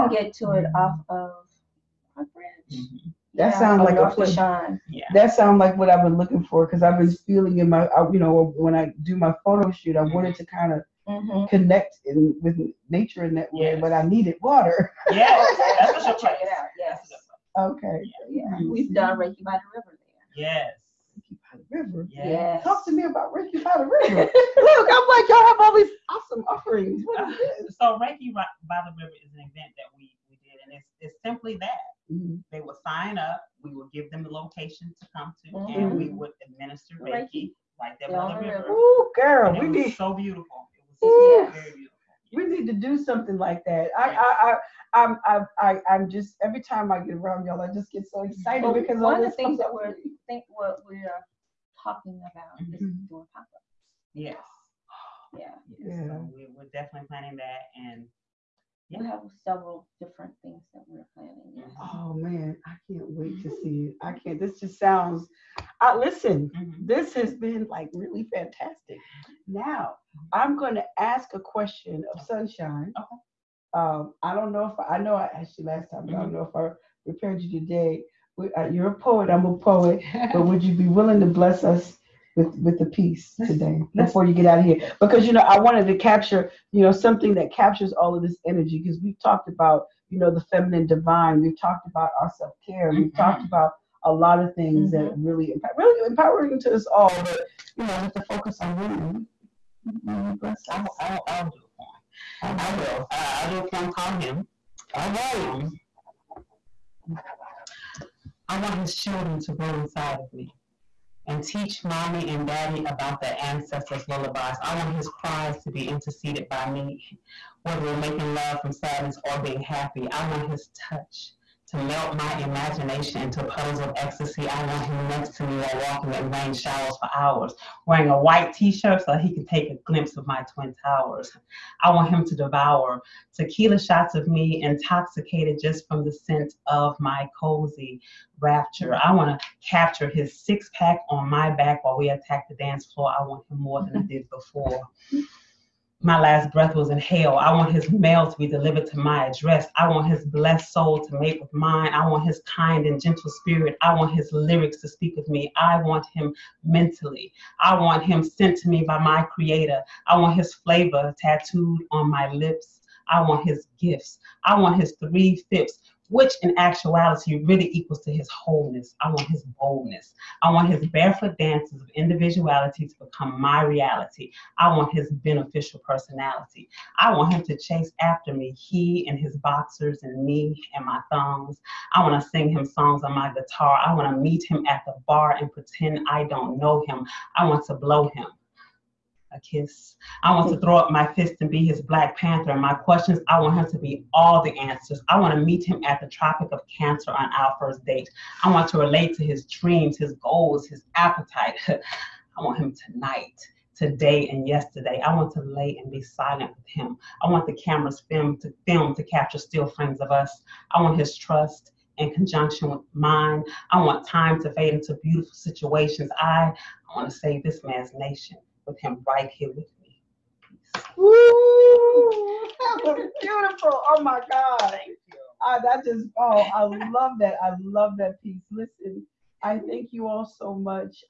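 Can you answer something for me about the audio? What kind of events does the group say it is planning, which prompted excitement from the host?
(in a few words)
Pop-ups.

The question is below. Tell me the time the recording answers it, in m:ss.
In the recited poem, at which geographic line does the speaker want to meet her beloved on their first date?
3:16.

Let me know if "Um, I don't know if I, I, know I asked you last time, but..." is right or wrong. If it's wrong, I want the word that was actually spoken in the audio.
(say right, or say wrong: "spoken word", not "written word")
right.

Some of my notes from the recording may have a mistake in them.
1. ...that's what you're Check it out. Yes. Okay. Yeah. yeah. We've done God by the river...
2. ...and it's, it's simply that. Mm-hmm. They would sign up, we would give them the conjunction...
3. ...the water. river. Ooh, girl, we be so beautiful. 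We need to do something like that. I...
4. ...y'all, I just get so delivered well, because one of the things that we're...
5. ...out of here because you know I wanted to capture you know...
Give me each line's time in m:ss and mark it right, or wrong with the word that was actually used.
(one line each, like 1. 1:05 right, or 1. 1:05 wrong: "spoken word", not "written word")
1. 0:15 wrong: "Reiki", not "God"
2. 0:30 wrong: "location", not "conjunction"
3. 0:38 wrong: "river", not "water"
4. 0:47 wrong: "excited", not "delivered"
5. 1:24 right.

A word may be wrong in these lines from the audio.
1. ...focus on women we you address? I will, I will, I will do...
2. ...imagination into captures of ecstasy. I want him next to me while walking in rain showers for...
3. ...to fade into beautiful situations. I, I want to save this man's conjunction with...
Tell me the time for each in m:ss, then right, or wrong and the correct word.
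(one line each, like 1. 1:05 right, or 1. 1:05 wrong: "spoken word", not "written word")
1. 1:38 wrong: "bless", not "address"
2. 2:02 wrong: "puddles", not "captures"
3. 3:34 wrong: "nation", not "conjunction".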